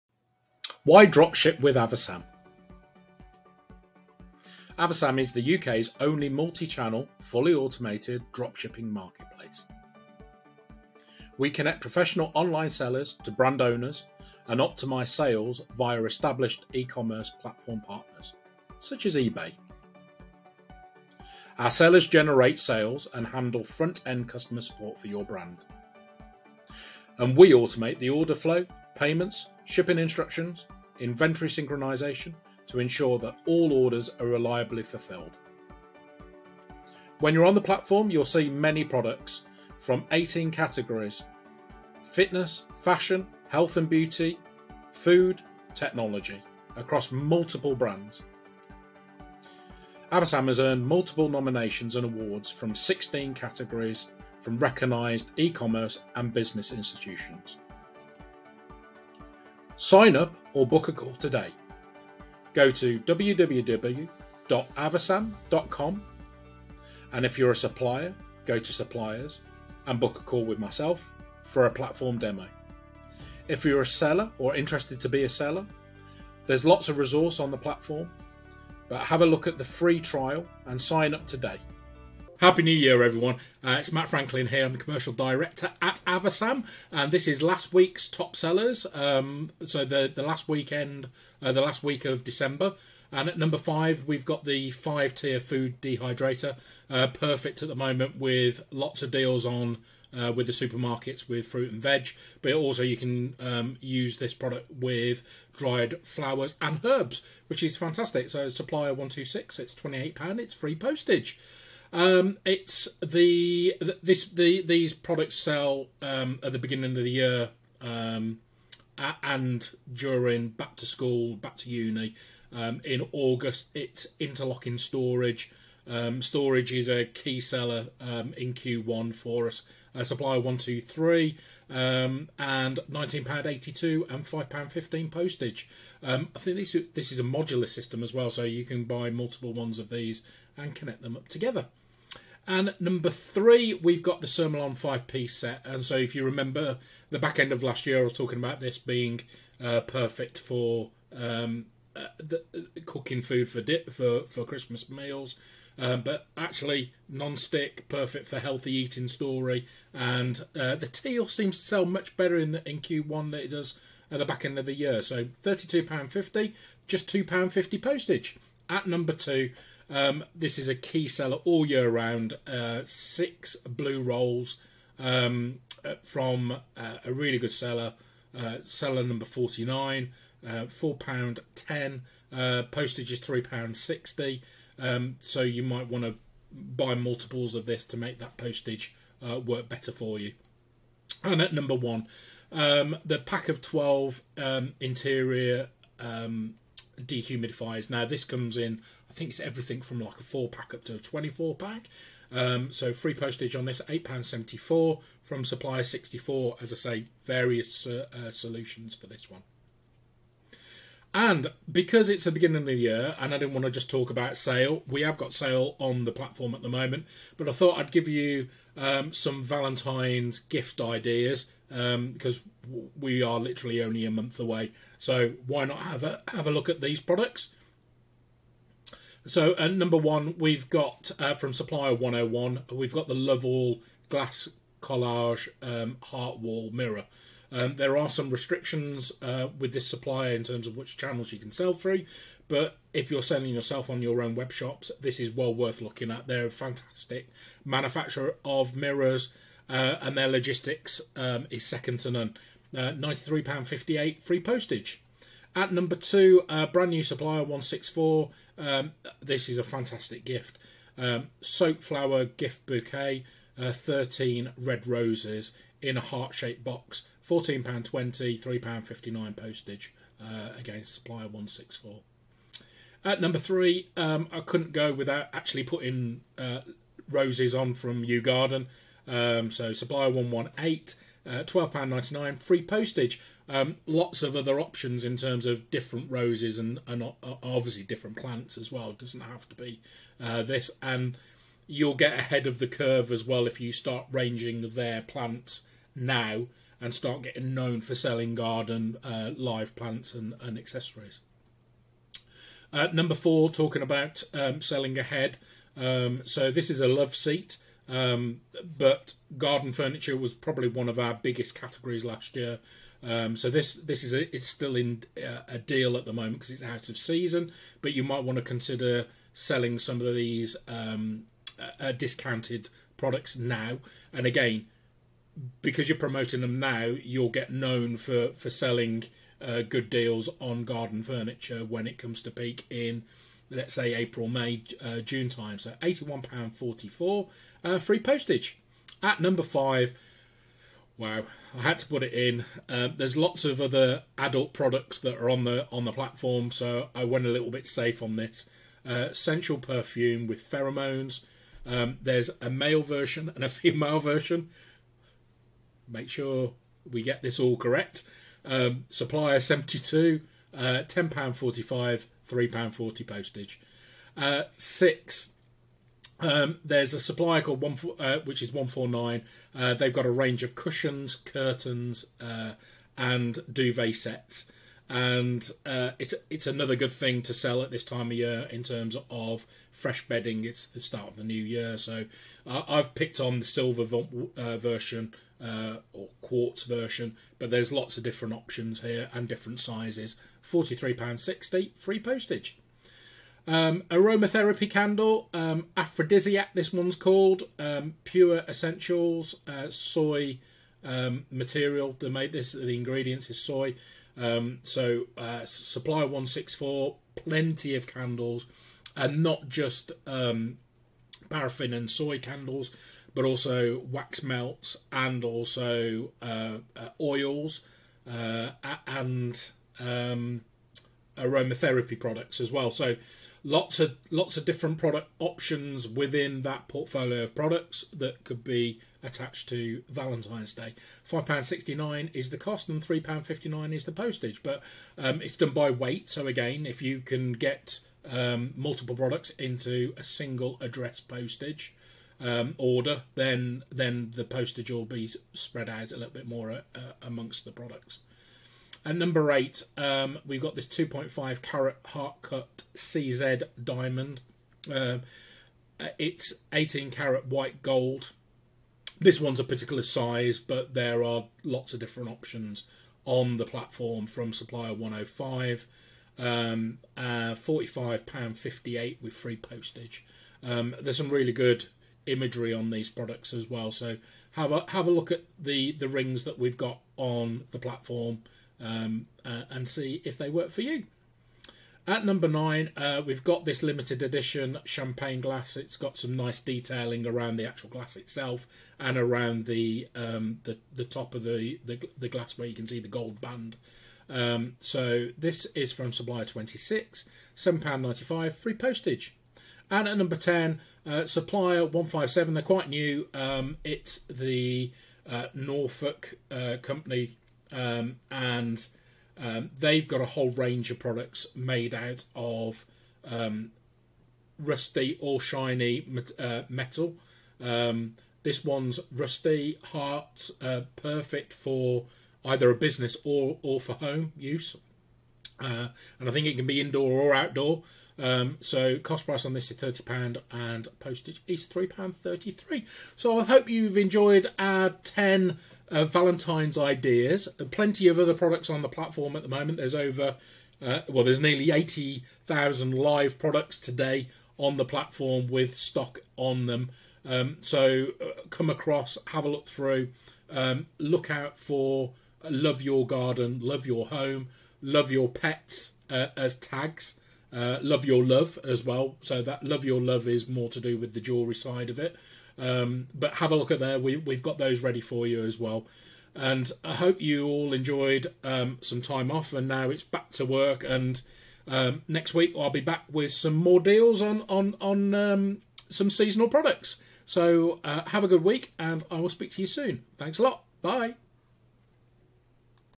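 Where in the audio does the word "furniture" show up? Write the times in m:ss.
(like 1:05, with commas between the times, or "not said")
5:09, 5:31.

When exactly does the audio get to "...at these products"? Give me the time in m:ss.
3:46.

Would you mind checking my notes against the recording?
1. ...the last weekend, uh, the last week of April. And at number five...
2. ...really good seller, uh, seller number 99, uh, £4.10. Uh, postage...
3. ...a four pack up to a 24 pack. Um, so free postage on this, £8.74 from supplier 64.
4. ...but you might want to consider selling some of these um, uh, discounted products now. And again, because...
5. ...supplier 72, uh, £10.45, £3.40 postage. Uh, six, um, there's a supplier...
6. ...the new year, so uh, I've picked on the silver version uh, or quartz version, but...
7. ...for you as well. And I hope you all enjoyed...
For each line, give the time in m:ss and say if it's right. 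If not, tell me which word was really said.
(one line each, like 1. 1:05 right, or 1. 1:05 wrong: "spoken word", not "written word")
1. 1:30 wrong: "December", not "April"
2. 2:57 wrong: "49", not "99"
3. 3:20 right
4. 5:17 right
5. 5:58 right
6. 6:21 right
7. 9:24 right.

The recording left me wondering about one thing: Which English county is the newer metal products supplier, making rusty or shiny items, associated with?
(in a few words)
Norfolk.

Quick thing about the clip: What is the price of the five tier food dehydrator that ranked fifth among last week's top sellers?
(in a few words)
£28.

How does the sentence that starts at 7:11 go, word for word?
Five pound sixty nine is the cost, and three pound fifty nine is the postage.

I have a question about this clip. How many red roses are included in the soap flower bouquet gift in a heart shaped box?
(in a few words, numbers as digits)
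13.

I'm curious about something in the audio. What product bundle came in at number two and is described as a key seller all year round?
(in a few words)
Six blue rolls.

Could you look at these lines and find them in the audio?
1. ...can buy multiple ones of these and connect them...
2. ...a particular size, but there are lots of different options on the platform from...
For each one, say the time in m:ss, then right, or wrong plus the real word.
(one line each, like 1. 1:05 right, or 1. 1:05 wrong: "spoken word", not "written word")
1. 2:18 right
2. 7:39 right.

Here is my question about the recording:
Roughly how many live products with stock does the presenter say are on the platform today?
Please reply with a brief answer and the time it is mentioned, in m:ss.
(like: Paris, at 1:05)
nearly 80,000, at 9:01.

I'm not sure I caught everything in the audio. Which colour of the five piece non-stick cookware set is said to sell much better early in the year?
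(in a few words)
Teal.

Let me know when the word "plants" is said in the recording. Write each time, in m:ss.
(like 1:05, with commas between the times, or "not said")
4:48, 4:55, 4:59.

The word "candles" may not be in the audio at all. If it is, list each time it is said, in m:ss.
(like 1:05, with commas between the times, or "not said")
6:34, 6:47, 6:52.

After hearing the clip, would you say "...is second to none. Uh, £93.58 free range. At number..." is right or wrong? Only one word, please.
wrong.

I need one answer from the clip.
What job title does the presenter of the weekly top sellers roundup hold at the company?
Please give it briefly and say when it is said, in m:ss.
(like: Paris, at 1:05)
Commercial director, at 1:24.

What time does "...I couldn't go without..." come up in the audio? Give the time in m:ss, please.
4:34.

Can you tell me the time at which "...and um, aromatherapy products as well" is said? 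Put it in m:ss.
6:58.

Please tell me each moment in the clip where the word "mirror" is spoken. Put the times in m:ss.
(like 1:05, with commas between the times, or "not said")
3:56, 4:08.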